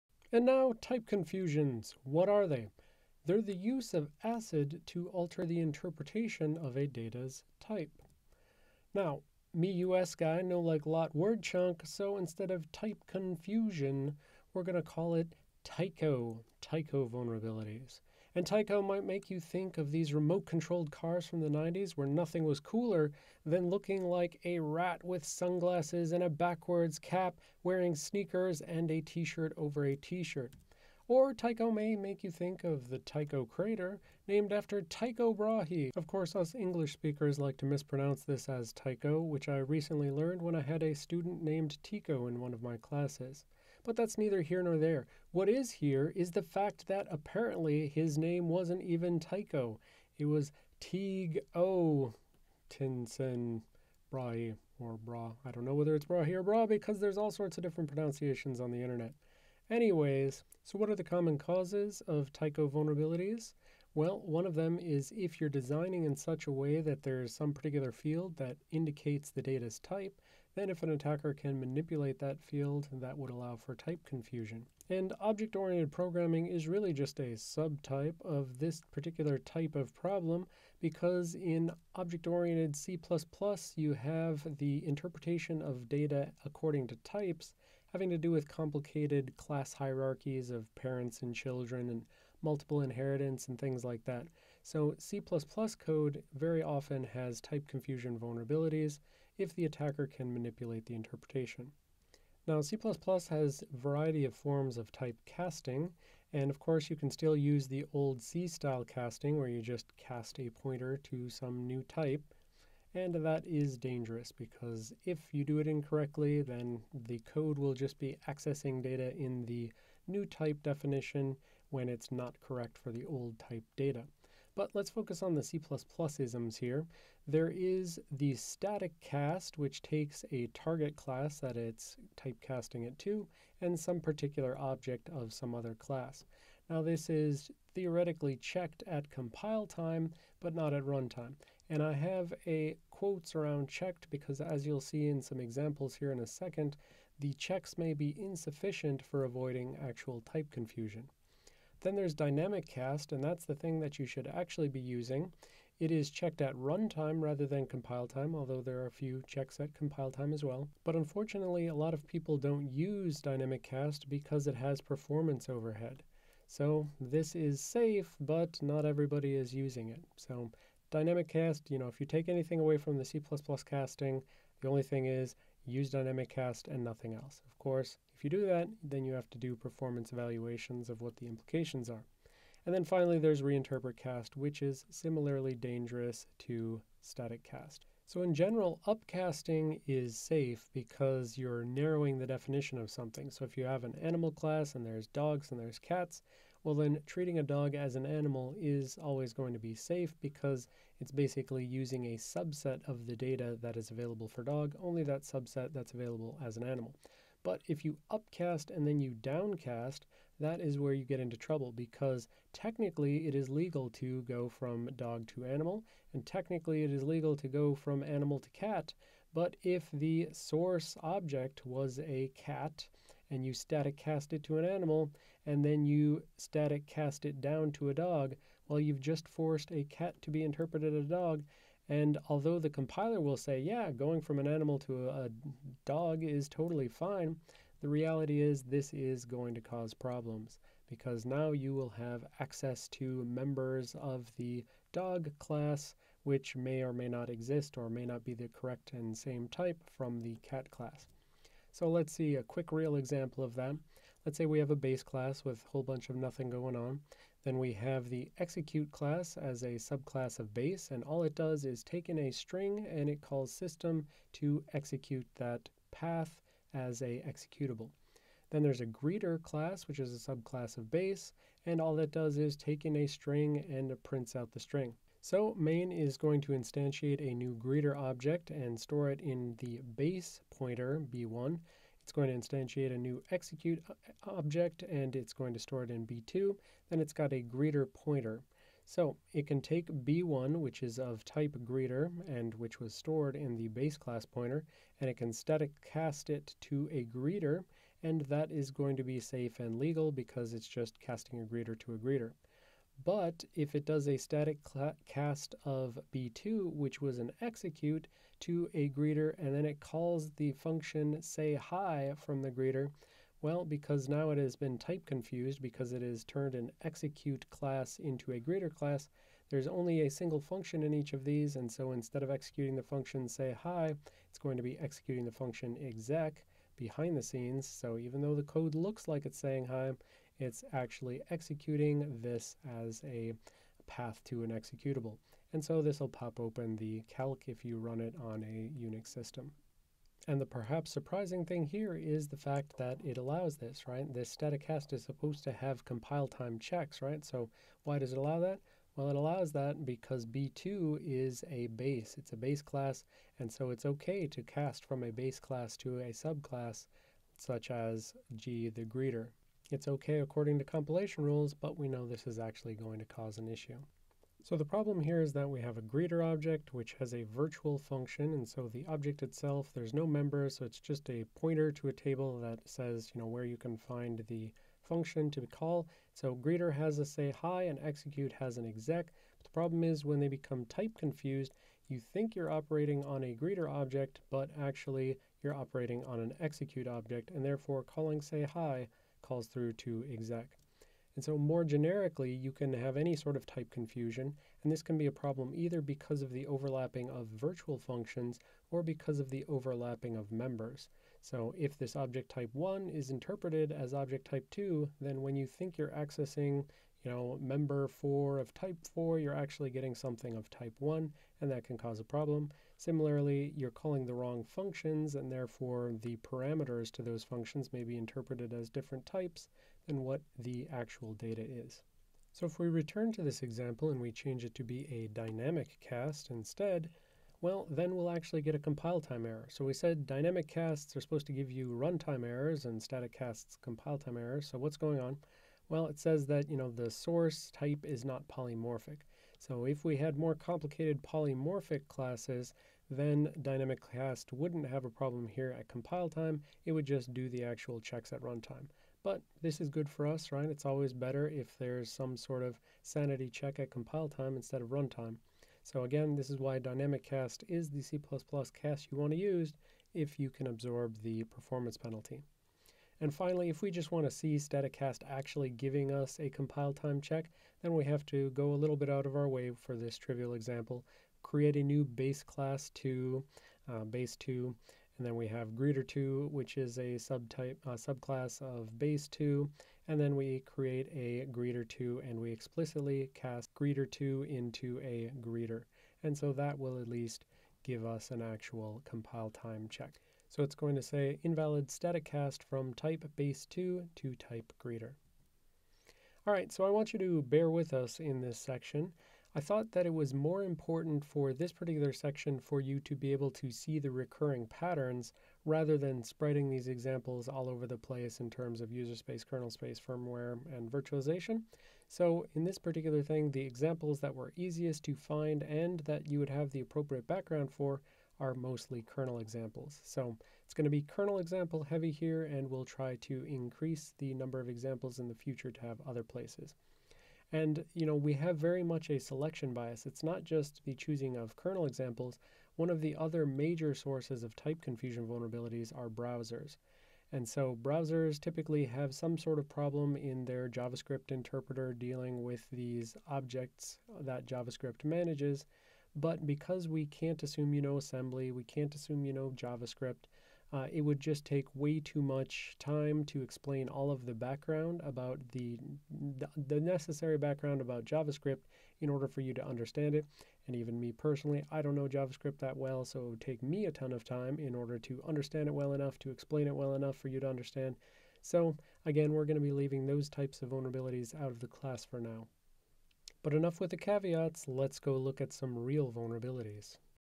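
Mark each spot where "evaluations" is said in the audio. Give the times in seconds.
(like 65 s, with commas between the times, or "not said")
180 s.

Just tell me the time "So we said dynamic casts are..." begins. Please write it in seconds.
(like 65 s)
429 s.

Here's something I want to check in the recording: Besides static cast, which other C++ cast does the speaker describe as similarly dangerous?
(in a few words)
reinterpret cast.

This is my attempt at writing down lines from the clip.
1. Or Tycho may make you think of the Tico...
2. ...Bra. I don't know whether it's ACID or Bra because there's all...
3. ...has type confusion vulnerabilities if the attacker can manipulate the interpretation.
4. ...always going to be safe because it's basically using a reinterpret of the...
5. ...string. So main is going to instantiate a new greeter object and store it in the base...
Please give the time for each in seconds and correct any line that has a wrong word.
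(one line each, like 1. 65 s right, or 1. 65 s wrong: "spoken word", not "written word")
1. 31 s wrong: "Tycho", not "Tico"
2. 54 s wrong: "Brahe", not "ACID"
3. 97 s right
4. 198 s wrong: "subset", not "reinterpret"
5. 274 s right.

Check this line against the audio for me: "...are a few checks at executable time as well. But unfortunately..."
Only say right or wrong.
wrong.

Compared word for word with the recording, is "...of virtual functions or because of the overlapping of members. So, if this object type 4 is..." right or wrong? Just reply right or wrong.
wrong.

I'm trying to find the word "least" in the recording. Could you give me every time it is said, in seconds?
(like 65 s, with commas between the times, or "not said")
486 s.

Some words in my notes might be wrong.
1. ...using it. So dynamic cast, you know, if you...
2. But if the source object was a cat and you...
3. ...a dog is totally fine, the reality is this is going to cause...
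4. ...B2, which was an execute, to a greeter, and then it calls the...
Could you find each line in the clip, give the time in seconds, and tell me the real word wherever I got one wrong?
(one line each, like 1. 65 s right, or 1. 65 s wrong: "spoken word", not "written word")
1. 169 s right
2. 219 s right
3. 235 s right
4. 306 s right.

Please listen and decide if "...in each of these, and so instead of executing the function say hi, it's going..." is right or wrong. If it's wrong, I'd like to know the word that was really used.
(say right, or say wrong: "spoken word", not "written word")
right.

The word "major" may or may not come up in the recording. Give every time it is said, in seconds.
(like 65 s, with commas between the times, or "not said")
533 s.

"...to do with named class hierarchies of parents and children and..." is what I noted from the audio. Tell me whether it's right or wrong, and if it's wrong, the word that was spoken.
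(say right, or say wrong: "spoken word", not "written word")
wrong: "complicated", not "named".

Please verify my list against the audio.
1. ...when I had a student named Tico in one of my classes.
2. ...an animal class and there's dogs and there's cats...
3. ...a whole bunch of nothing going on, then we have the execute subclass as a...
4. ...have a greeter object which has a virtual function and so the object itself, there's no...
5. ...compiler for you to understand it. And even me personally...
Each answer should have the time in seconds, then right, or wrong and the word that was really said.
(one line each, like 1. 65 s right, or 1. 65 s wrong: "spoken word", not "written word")
1. 40 s right
2. 193 s right
3. 255 s wrong: "class", not "subclass"
4. 365 s right
5. 558 s wrong: "order", not "compiler".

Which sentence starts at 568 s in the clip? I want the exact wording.
So again, we're going to be leaving those types of vulnerabilities out of the class for now.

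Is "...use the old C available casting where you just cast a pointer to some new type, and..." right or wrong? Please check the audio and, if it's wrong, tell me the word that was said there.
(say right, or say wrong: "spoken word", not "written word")
wrong: "style", not "available".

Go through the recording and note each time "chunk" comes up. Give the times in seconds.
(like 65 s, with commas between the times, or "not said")
11 s.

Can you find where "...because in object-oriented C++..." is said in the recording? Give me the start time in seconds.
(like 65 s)
80 s.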